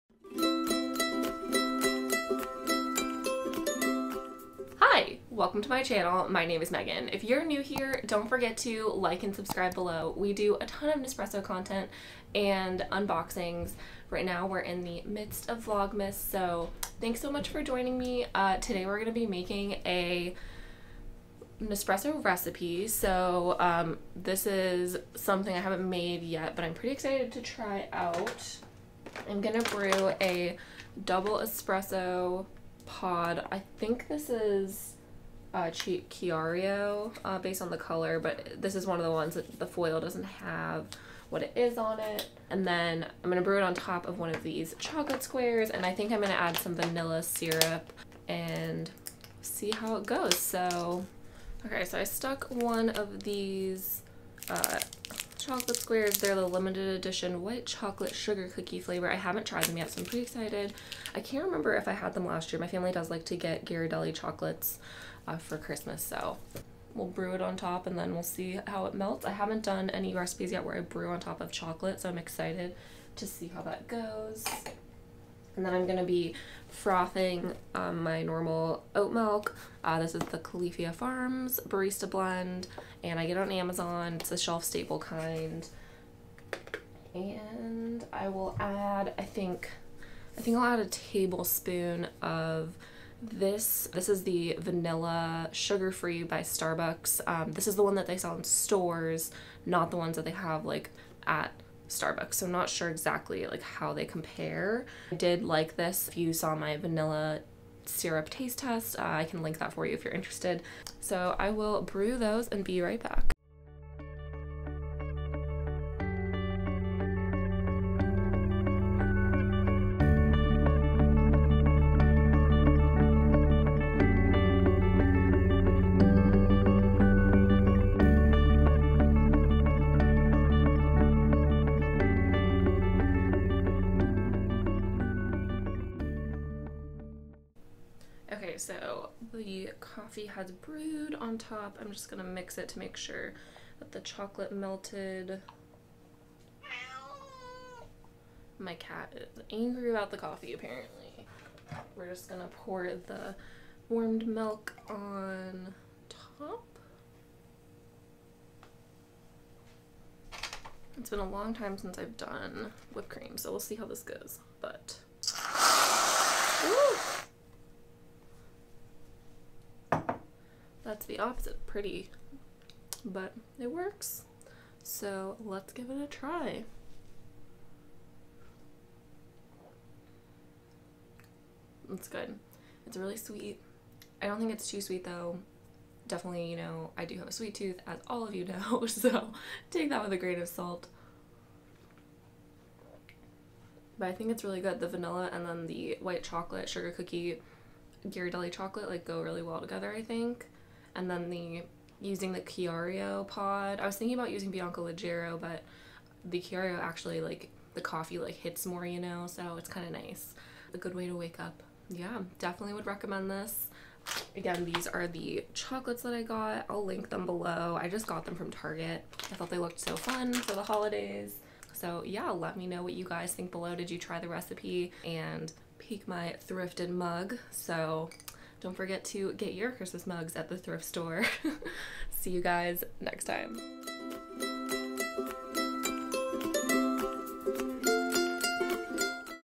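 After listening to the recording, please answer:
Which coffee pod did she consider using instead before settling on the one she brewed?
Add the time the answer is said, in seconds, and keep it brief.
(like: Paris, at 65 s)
Bianco Leggero, at 204 s.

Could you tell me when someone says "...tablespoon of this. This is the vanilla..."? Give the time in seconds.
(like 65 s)
90 s.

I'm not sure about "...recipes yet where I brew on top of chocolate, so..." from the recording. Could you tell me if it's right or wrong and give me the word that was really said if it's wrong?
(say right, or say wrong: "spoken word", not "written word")
right.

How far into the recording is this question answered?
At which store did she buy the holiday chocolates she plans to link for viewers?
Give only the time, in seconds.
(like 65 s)
218 s.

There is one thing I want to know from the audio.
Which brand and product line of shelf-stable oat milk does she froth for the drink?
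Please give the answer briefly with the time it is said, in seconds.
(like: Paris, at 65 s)
Califia Farms Barista Blend, at 80 s.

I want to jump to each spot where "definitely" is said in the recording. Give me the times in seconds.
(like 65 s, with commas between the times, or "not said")
186 s, 212 s.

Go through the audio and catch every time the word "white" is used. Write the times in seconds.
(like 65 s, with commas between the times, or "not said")
57 s, 196 s.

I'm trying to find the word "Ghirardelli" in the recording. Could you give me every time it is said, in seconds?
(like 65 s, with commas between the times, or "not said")
63 s, 198 s.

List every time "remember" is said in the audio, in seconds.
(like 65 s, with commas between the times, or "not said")
61 s.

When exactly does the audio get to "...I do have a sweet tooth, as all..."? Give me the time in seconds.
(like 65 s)
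186 s.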